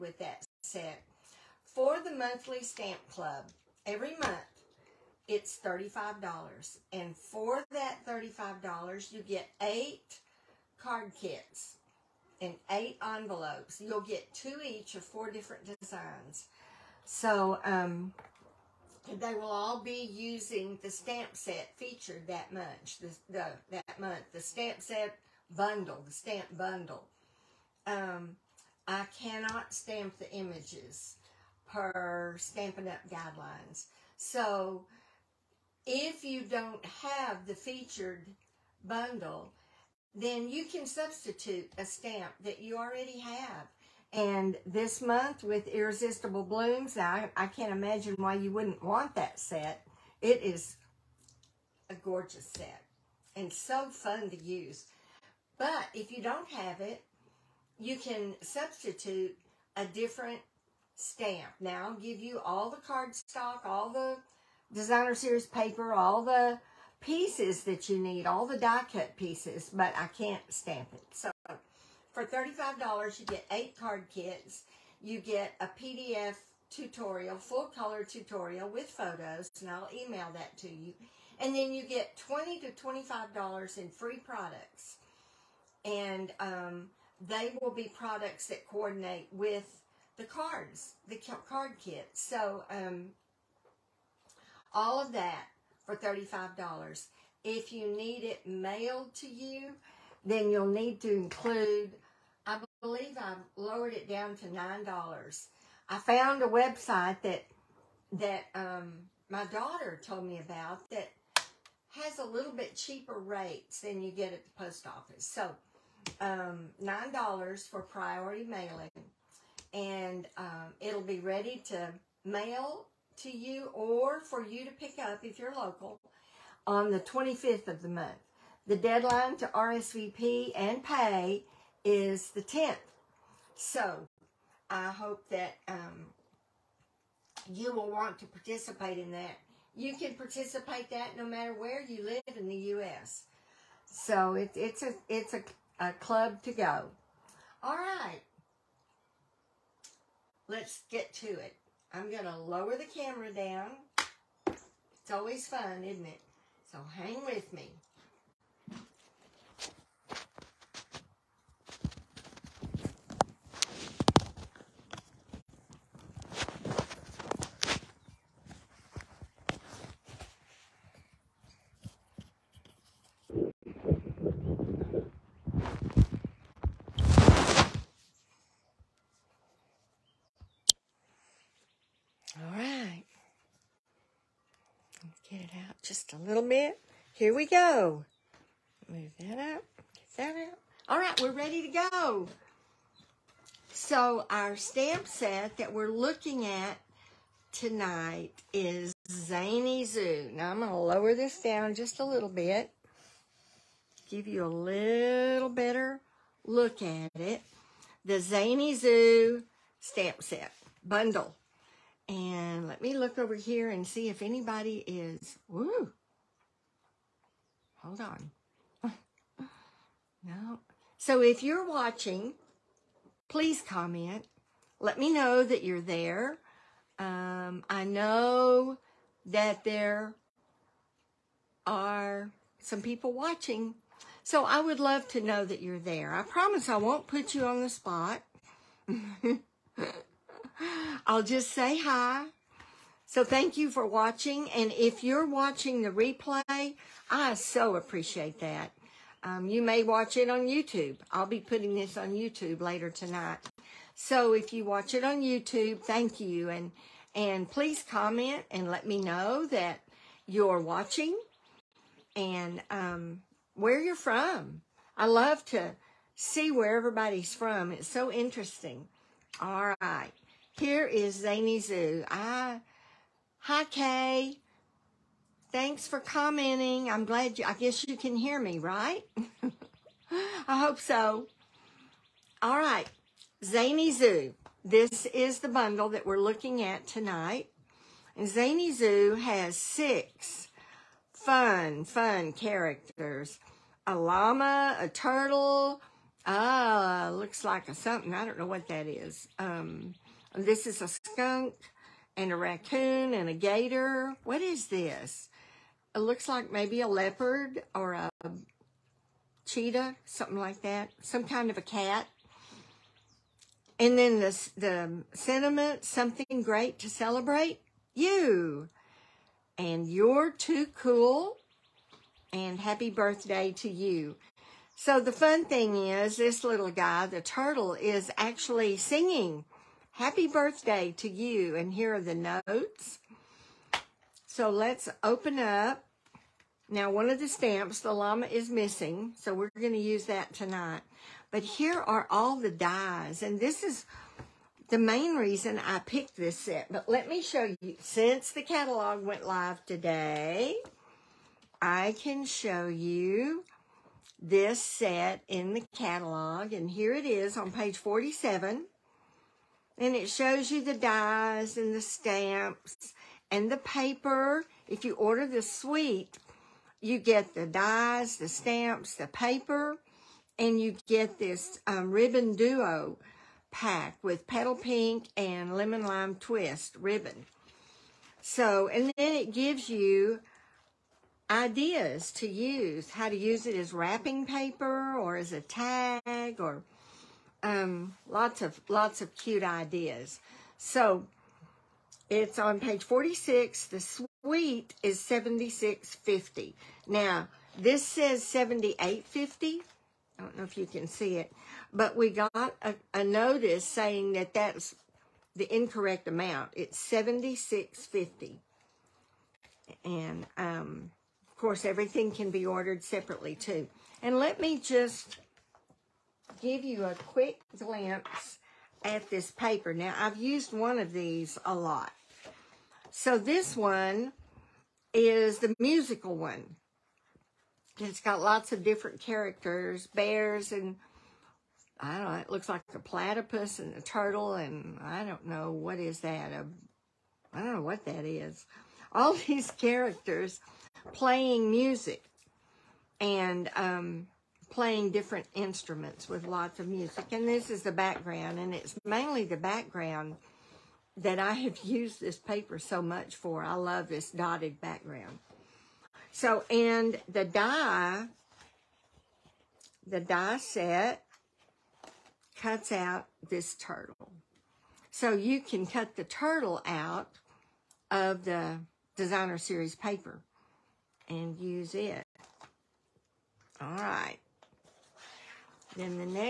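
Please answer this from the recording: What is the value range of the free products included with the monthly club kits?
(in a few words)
$20 to $25.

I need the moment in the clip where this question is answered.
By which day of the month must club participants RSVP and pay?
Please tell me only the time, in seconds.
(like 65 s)
132 s.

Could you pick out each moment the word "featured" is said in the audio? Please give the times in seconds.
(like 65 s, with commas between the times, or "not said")
21 s, 37 s.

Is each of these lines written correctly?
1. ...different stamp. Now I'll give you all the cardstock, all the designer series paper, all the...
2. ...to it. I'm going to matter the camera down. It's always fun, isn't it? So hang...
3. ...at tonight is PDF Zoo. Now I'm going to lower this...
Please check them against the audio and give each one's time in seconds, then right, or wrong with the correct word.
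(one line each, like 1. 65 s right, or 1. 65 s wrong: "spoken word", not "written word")
1. 59 s right
2. 151 s wrong: "lower", not "matter"
3. 196 s wrong: "Zany", not "PDF".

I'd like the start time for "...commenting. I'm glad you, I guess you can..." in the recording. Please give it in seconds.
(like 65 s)
275 s.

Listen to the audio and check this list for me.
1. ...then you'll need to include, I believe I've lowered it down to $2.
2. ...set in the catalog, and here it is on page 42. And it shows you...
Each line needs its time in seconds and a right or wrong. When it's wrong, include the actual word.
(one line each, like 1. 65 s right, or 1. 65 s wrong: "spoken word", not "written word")
1. 100 s wrong: "9", not "2"
2. 354 s wrong: "47", not "42".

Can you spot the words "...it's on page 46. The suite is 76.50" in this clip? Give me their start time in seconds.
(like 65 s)
392 s.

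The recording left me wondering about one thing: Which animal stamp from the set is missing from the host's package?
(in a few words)
The llama.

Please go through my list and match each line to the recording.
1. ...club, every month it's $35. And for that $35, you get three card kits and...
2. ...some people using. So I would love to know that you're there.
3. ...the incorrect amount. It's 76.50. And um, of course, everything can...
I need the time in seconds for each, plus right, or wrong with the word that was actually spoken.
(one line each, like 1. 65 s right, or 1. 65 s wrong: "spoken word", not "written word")
1. 3 s wrong: "eight", not "three"
2. 232 s wrong: "watching", not "using"
3. 405 s right.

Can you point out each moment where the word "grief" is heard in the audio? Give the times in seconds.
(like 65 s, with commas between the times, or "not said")
not said.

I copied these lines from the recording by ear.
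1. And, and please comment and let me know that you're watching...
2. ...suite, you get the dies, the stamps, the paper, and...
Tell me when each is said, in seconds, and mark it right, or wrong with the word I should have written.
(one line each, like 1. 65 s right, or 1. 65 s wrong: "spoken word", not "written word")
1. 256 s right
2. 365 s right.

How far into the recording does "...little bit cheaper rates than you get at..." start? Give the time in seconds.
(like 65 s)
112 s.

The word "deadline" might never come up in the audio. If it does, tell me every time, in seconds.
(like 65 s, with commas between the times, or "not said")
128 s.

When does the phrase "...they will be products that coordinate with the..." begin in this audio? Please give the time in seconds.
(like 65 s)
87 s.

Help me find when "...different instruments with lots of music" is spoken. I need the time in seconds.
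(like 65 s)
444 s.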